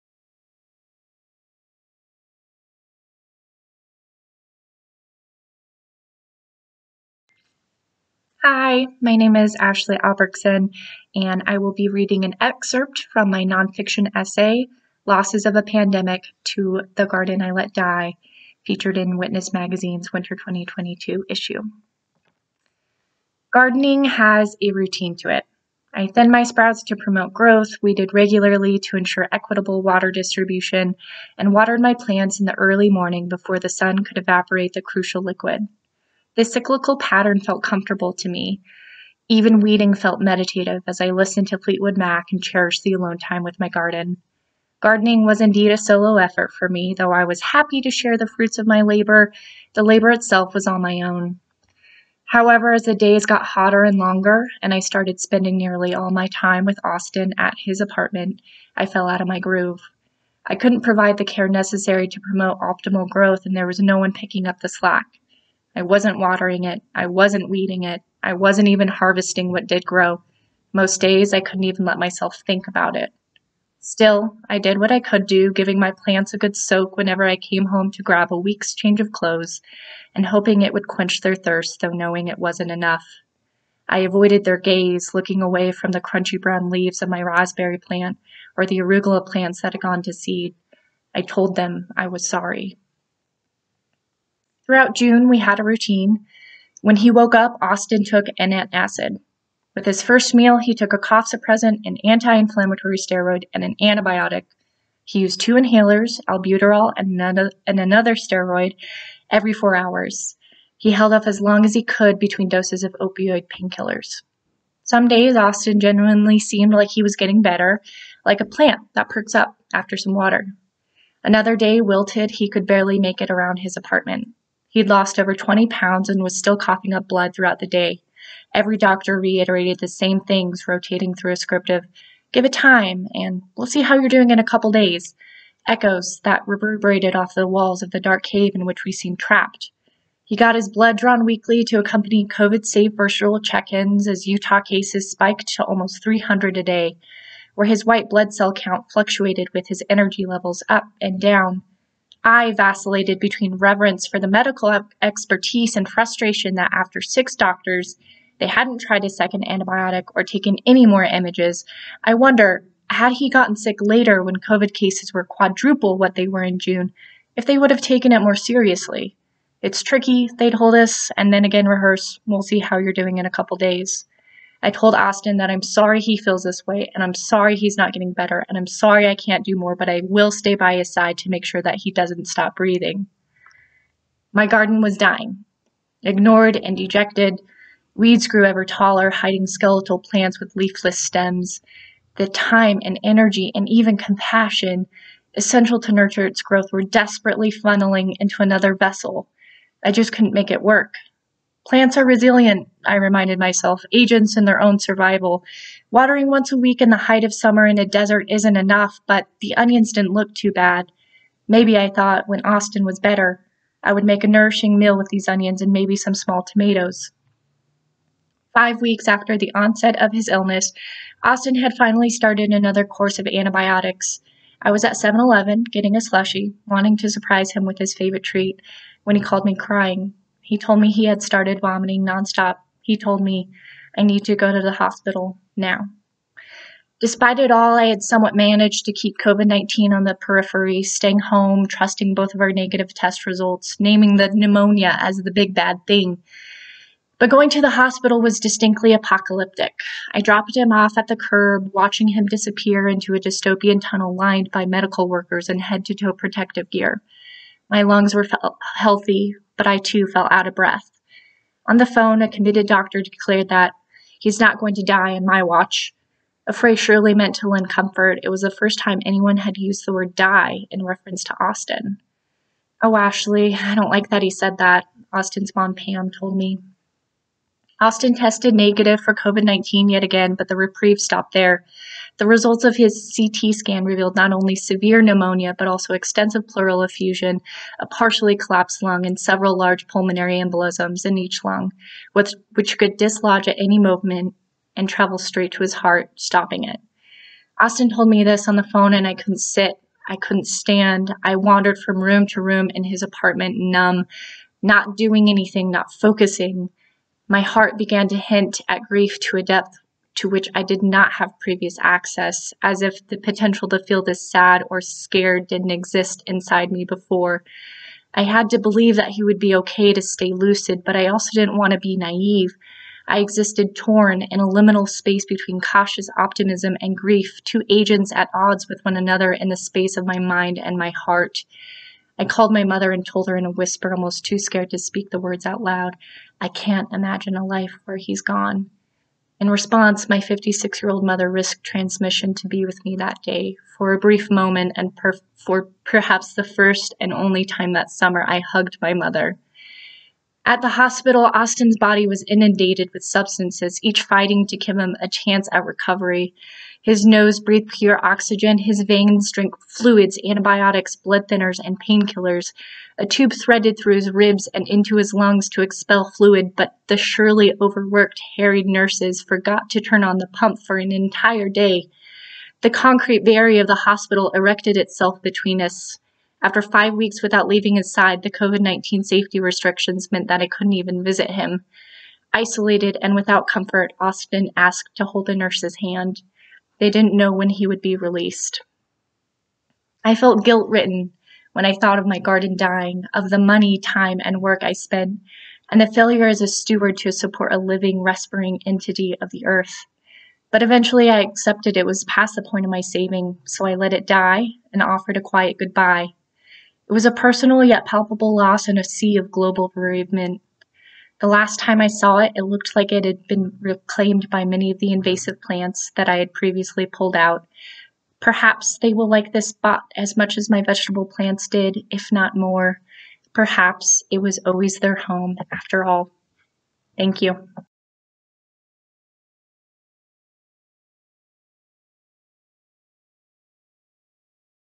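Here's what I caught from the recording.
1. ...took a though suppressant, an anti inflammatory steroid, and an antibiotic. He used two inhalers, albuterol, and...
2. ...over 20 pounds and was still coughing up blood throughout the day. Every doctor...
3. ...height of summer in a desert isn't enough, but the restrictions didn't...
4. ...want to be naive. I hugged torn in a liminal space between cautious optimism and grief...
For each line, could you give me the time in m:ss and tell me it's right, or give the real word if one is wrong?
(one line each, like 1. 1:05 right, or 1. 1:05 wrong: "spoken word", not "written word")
1. 1:40 wrong: "cough", not "though"
2. 2:05 right
3. 3:26 wrong: "onions", not "restrictions"
4. 5:21 wrong: "existed", not "hugged".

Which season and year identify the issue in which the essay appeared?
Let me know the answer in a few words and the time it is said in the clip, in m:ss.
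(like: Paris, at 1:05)
Winter 2022, at 0:20.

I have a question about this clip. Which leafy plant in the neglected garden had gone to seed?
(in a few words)
Arugula.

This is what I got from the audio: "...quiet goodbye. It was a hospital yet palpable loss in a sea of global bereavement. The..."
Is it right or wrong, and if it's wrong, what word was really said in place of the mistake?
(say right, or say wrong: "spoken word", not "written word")
wrong: "personal", not "hospital".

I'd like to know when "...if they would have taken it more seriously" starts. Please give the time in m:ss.
2:47.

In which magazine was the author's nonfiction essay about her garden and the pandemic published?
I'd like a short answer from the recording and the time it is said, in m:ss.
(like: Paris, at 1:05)
Witness Magazine, at 0:19.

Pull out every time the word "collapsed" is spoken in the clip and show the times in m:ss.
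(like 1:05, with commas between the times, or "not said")
4:48.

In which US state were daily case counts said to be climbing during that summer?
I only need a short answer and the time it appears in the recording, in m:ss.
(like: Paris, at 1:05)
Utah, at 2:24.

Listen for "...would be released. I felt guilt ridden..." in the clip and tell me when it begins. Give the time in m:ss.
6:27.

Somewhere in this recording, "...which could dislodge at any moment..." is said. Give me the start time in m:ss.
4:52.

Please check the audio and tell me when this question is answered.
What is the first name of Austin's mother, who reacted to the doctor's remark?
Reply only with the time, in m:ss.
4:35.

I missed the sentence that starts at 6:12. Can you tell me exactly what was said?
The concrete barrier of the hospital erected itself between us.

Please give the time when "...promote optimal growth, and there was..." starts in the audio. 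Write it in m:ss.
1:02.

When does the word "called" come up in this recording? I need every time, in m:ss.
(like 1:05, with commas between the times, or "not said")
3:49, 5:32.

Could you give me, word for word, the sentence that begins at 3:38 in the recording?
Five weeks after the onset of his illness, Austin had finally started another course of antibiotics.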